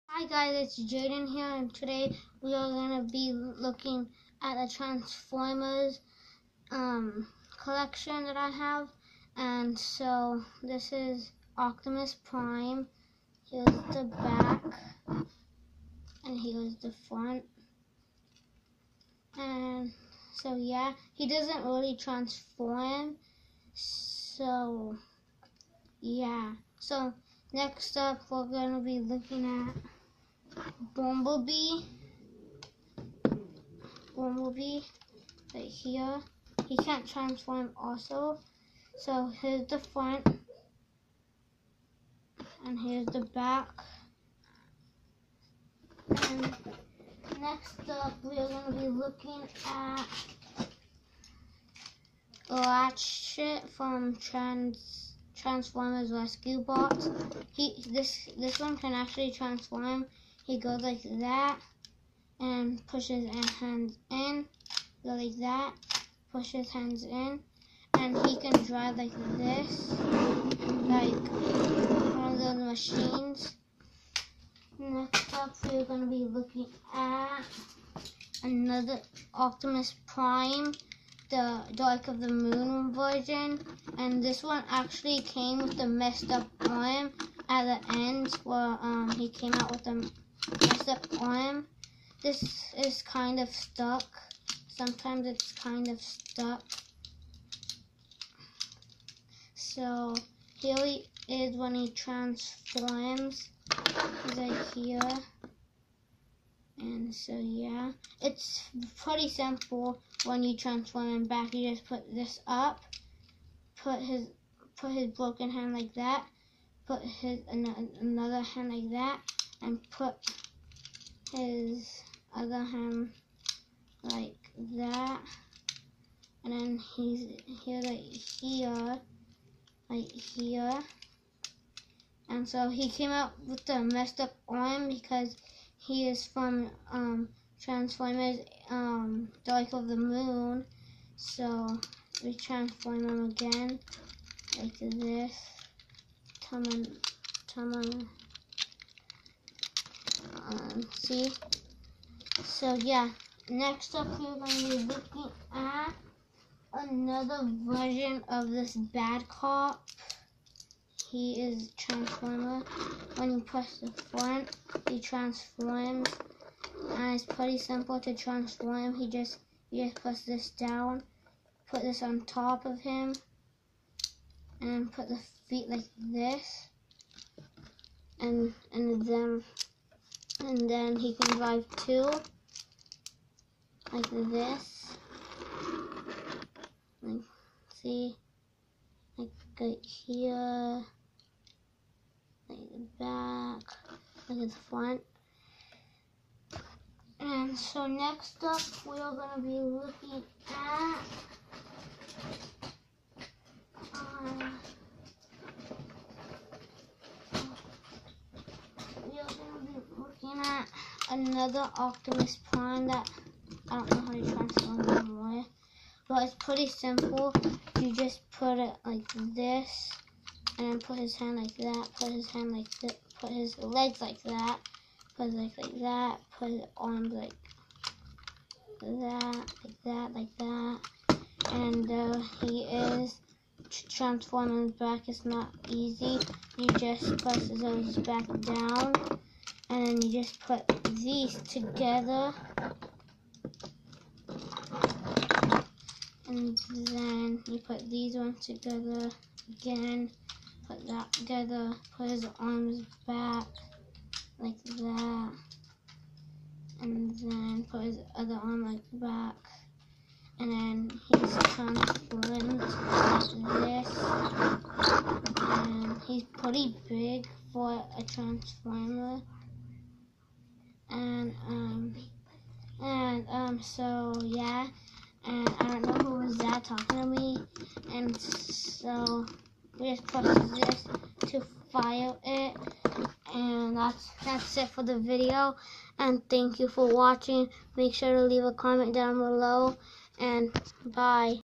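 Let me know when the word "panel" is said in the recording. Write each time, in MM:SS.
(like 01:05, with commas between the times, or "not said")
not said.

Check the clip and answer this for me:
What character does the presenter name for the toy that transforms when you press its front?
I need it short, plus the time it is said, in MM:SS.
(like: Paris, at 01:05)
Bad cop, at 02:38.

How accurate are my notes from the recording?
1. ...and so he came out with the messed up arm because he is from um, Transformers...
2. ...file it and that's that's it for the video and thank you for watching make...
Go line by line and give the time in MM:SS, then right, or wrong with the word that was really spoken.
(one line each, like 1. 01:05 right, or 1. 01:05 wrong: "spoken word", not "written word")
1. 02:12 right
2. 04:41 right.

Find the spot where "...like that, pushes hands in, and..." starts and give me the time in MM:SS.
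01:05.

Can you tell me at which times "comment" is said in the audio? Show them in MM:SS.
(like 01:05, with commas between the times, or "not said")
04:48.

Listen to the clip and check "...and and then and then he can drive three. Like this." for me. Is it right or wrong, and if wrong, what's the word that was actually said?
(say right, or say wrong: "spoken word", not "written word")
wrong: "two", not "three".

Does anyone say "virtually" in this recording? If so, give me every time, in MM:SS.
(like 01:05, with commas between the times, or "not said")
not said.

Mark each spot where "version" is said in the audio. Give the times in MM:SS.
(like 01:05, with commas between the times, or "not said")
01:22, 02:37.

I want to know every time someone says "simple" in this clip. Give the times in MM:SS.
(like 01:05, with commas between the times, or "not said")
01:49, 02:47, 03:36.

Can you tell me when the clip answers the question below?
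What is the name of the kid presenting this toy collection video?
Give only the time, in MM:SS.
00:00.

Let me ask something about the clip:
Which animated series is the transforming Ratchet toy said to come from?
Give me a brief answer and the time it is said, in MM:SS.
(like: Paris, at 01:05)
Transformers Rescue Bots, at 00:54.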